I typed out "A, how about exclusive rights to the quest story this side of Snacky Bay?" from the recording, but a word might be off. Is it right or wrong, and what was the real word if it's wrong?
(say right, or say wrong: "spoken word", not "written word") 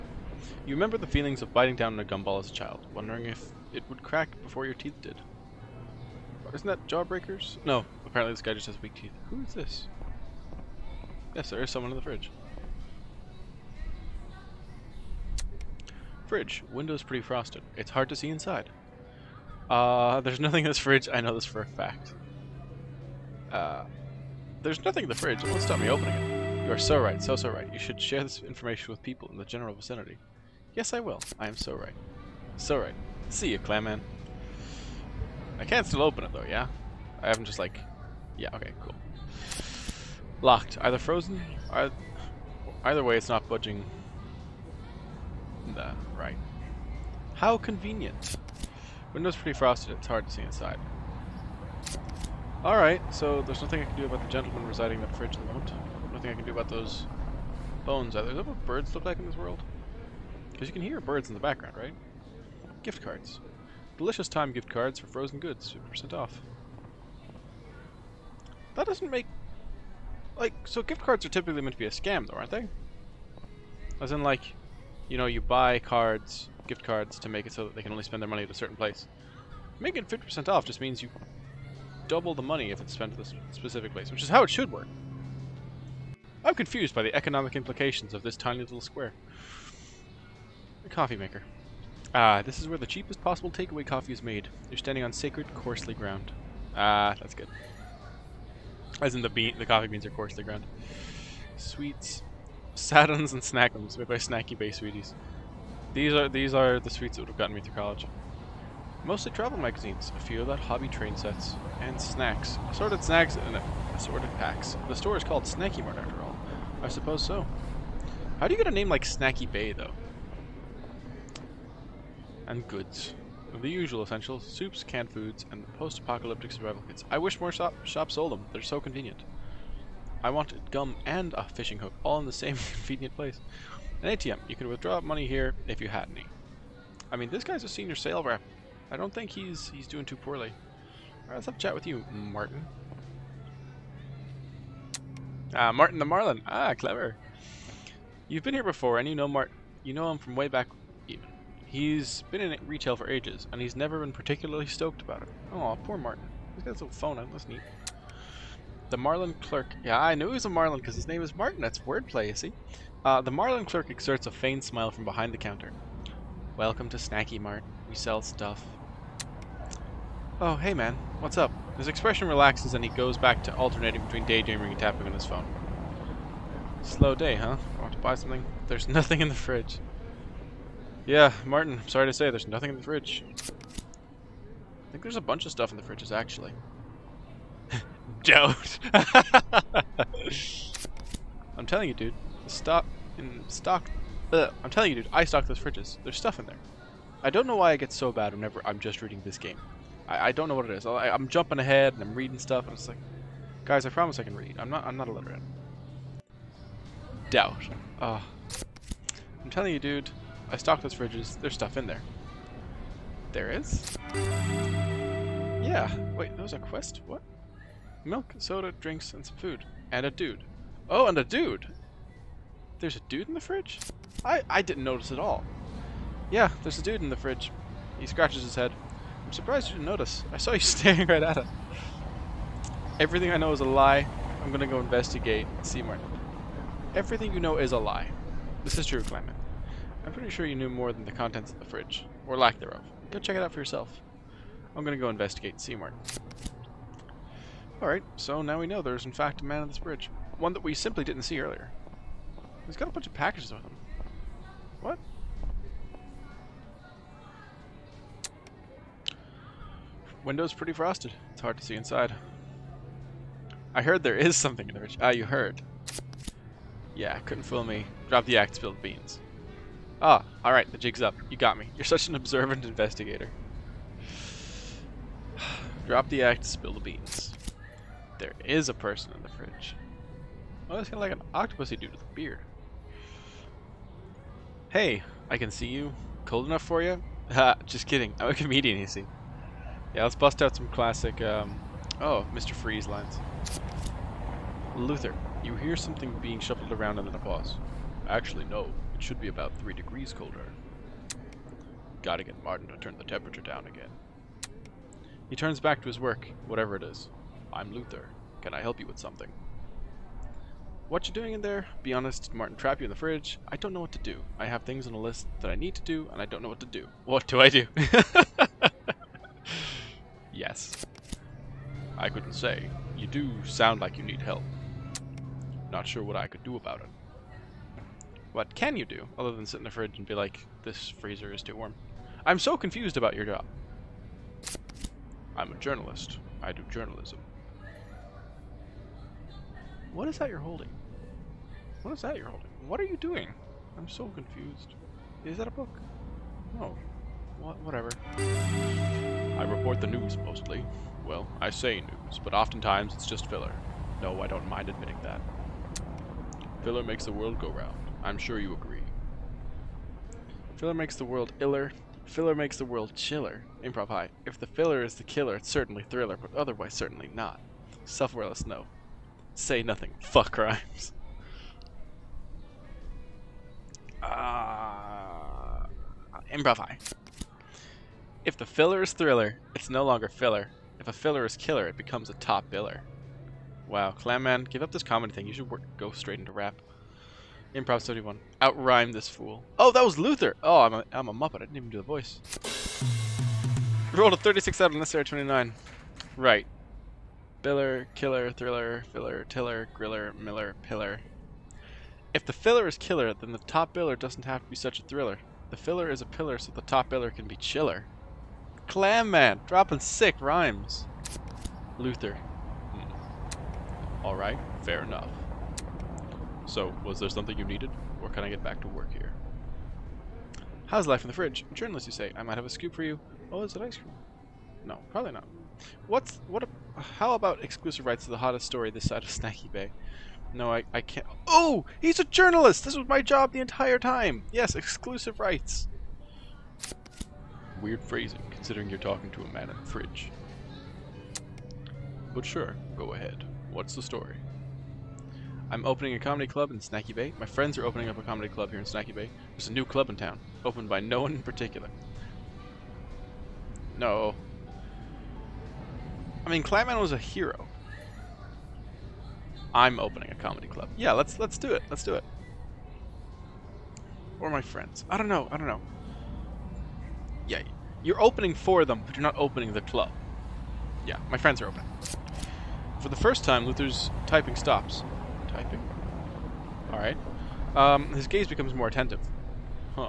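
wrong: "hottest", not "quest".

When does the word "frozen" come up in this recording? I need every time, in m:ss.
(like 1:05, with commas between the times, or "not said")
0:40, 1:05.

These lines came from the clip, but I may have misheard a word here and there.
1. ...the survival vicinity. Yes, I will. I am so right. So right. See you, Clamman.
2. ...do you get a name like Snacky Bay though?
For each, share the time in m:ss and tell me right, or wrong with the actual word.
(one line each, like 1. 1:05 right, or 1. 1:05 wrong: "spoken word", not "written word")
1. 0:29 wrong: "general", not "survival"
2. 1:58 right.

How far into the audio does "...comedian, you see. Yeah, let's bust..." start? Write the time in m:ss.
4:48.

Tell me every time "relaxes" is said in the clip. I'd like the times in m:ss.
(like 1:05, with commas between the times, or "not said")
2:52.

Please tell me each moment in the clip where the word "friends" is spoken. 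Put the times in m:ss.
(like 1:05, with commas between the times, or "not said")
7:27, 7:44, 7:51.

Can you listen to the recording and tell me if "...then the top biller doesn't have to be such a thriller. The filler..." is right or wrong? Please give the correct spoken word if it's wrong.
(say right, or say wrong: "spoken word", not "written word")
right.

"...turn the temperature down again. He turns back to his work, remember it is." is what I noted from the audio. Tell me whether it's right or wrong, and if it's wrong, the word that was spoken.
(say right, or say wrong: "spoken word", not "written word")
wrong: "whatever", not "remember".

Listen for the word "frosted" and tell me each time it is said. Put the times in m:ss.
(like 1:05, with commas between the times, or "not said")
0:17, 0:49, 4:20.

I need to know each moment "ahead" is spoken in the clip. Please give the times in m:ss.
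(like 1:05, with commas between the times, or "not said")
3:21, 7:22.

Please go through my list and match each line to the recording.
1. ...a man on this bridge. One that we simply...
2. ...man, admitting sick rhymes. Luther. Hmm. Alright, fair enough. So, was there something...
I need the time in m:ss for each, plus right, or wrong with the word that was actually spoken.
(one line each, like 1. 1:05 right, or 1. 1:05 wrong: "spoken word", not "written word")
1. 4:09 right
2. 6:49 wrong: "dropping", not "admitting".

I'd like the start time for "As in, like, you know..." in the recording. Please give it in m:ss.
1:14.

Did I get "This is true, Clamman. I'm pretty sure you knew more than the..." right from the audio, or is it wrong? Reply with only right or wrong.
right.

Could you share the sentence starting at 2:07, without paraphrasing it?
I wish more shop shops sold them.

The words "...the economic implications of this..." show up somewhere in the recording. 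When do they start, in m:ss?
1:27.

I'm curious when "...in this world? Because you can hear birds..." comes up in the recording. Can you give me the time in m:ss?
0:59.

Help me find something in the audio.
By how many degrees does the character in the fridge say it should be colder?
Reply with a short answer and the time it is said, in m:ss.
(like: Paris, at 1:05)
3, at 4:59.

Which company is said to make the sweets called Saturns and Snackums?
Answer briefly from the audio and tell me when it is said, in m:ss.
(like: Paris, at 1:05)
Snacky Bay Sweeties, at 1:44.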